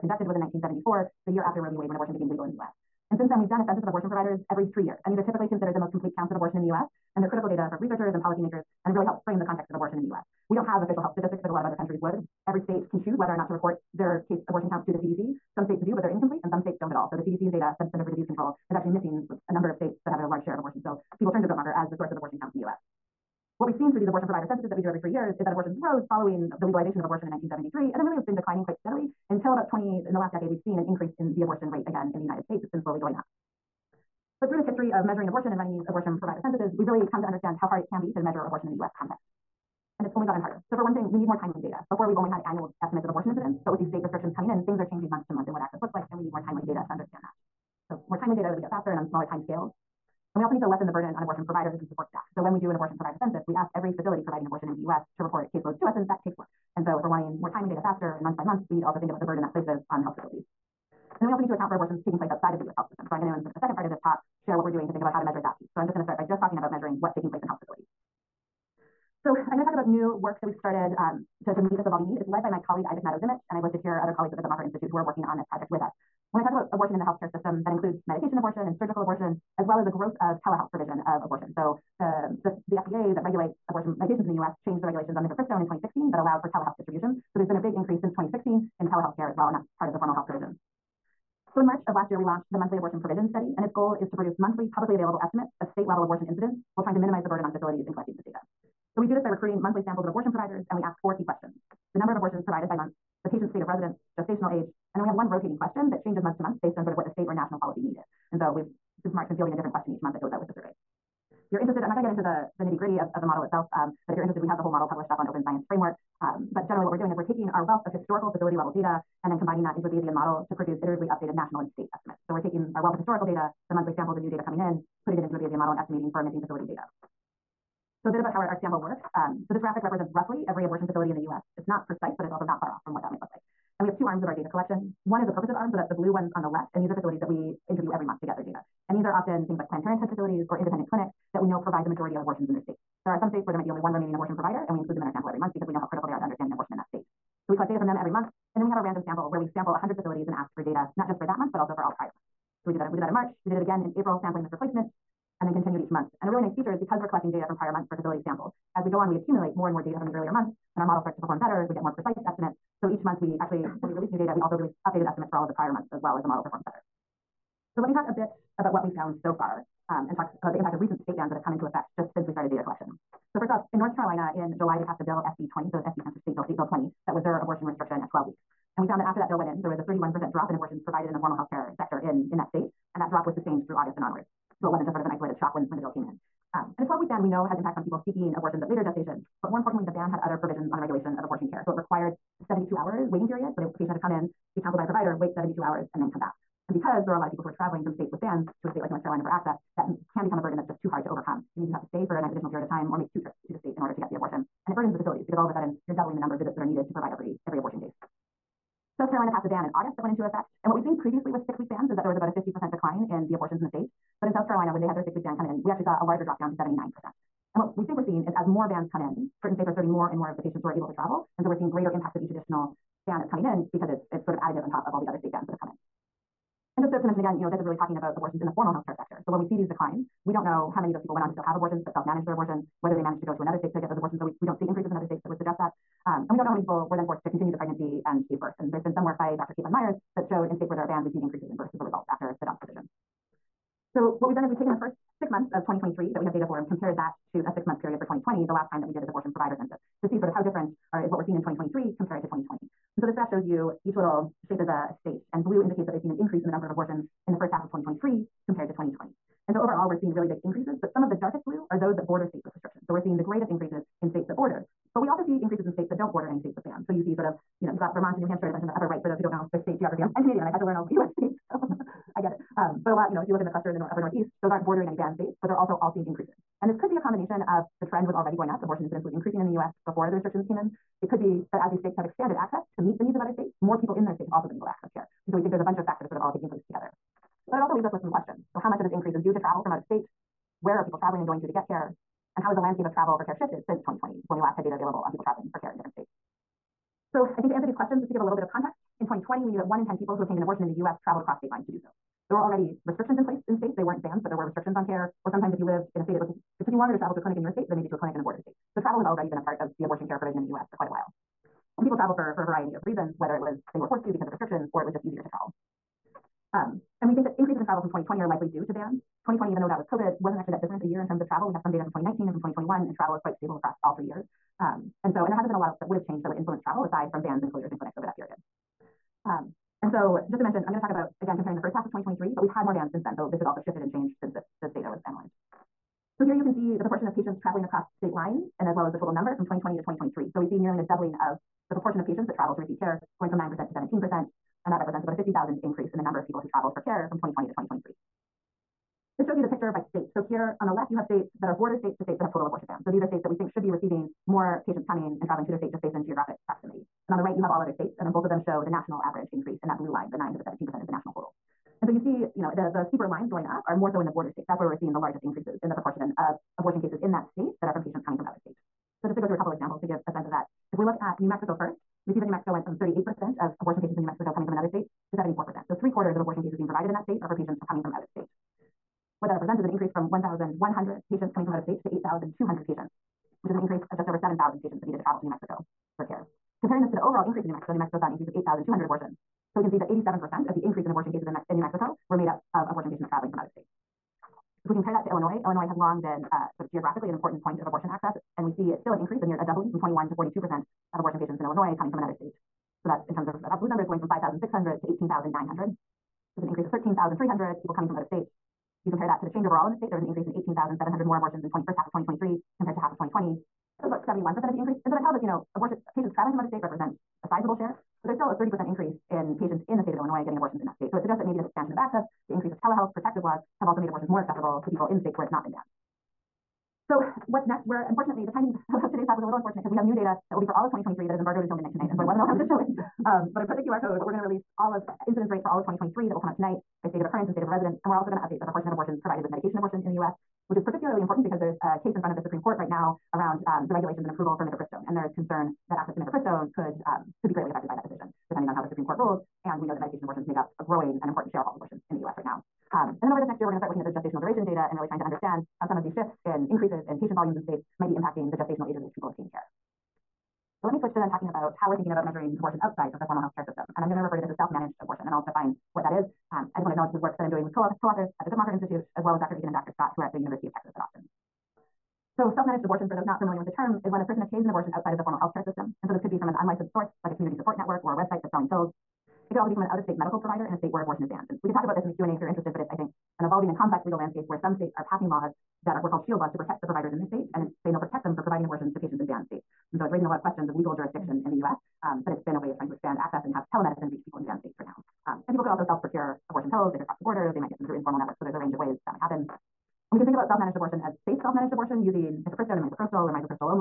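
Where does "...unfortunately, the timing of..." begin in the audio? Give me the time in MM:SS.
07:07.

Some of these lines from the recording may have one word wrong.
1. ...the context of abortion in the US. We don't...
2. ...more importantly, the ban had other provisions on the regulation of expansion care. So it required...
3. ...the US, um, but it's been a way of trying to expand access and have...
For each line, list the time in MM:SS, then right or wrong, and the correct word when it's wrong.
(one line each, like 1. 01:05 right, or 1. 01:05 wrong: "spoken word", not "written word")
1. 00:09 right
2. 03:09 wrong: "abortion", not "expansion"
3. 08:11 right.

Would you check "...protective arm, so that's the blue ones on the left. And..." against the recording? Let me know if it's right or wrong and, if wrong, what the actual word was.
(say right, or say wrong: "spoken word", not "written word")
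wrong: "purposive", not "protective".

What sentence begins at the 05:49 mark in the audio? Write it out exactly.
This shows you the picture by state.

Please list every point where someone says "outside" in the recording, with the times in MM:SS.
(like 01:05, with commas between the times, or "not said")
01:02, 07:42, 07:54.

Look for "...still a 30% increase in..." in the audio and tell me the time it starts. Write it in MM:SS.
06:58.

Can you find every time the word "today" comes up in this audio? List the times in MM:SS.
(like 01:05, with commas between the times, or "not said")
07:08.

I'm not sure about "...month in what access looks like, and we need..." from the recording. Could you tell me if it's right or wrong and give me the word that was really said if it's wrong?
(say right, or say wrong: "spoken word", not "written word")
right.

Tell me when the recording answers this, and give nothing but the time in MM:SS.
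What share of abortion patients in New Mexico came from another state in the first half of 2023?
06:15.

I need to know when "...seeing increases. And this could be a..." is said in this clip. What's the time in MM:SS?
04:35.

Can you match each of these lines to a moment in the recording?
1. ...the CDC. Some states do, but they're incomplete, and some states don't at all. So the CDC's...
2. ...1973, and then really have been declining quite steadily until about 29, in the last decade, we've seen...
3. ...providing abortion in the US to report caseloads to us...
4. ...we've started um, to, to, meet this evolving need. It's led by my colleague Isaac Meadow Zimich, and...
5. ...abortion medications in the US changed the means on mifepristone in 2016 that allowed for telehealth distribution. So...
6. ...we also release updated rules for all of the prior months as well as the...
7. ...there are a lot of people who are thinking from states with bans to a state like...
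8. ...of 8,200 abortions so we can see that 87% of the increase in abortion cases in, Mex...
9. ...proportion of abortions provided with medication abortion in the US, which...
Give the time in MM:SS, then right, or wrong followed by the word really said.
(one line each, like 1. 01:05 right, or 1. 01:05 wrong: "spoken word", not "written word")
1. 00:14 right
2. 00:27 wrong: "20", not "29"
3. 00:54 right
4. 01:10 right
5. 01:23 wrong: "regulations", not "means"
6. 02:44 wrong: "estimates", not "rules"
7. 03:17 wrong: "traveling", not "thinking"
8. 06:28 right
9. 07:18 right.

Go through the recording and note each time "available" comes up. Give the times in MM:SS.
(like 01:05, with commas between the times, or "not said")
01:34, 04:54.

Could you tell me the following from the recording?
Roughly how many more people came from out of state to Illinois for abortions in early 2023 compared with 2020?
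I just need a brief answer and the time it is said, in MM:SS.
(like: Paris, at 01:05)
13,300, at 06:46.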